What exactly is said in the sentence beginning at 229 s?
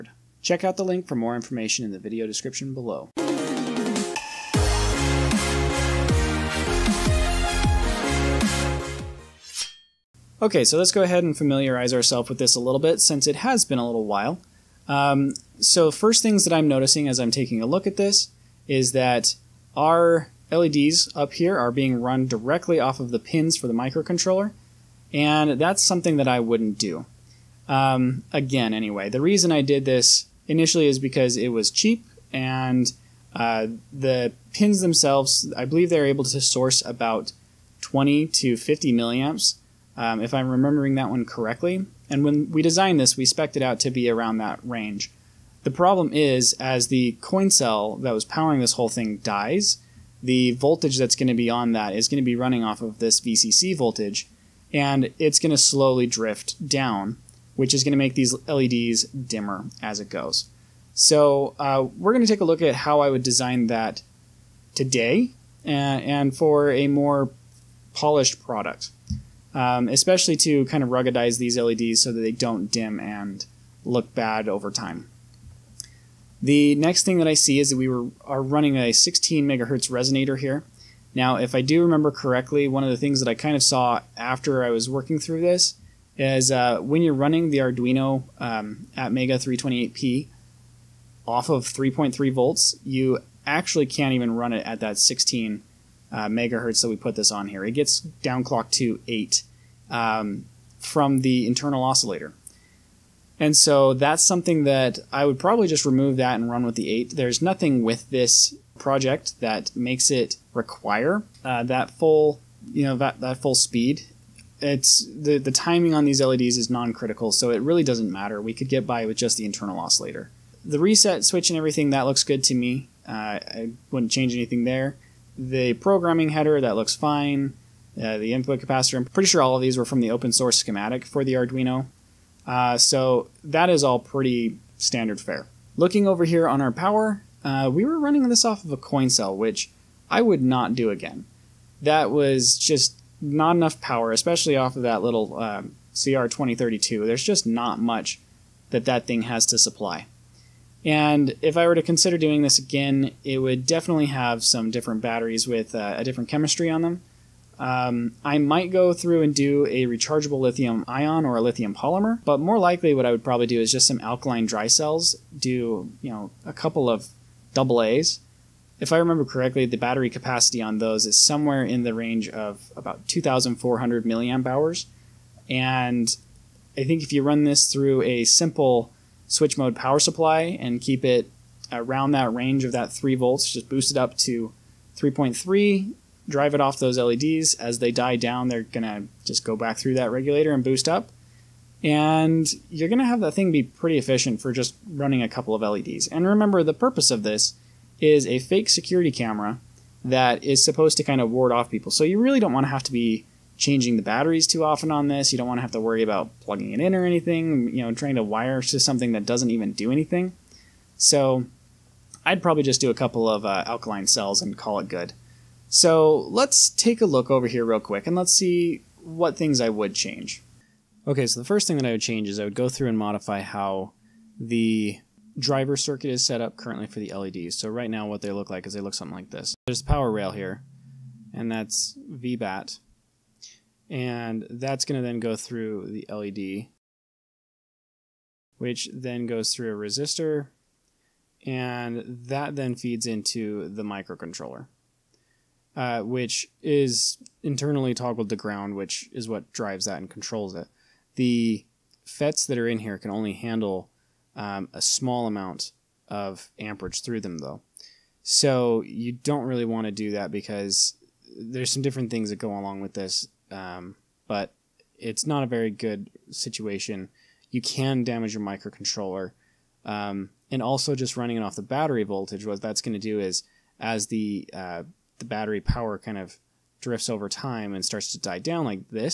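There's a power rail here, and that's VBAT.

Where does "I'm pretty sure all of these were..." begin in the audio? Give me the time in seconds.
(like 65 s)
128 s.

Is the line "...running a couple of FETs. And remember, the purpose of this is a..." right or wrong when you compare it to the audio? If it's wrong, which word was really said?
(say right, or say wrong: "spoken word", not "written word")
wrong: "LEDs", not "FETs".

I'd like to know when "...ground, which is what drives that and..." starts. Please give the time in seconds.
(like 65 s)
248 s.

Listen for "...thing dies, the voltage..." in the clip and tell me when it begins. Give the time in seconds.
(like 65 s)
48 s.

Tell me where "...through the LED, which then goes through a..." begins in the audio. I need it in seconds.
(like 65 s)
235 s.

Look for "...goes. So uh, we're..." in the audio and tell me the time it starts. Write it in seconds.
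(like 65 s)
60 s.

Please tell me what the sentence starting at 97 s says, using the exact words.
It gets downclocked to 8 um, from the internal oscillator.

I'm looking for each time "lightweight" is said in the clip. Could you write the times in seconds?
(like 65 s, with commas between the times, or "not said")
not said.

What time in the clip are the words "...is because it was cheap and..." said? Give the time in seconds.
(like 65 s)
30 s.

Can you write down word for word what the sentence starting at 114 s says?
It's the, the timing on these LEDs is non-critical, so it really doesn't matter.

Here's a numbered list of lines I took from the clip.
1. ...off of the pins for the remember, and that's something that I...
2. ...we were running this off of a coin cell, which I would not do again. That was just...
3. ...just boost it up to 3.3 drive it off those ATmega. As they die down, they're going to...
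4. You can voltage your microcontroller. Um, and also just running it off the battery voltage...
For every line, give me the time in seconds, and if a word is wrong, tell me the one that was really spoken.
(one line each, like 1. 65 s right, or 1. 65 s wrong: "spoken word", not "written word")
1. 22 s wrong: "microcontroller", not "remember"
2. 137 s right
3. 183 s wrong: "LEDs", not "ATmega"
4. 267 s wrong: "damage", not "voltage".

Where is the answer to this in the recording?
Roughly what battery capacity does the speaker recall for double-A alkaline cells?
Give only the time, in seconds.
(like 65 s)
173 s.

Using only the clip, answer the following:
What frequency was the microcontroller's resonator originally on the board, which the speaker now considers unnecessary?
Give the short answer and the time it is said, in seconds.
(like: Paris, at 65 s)
16 MHz, at 78 s.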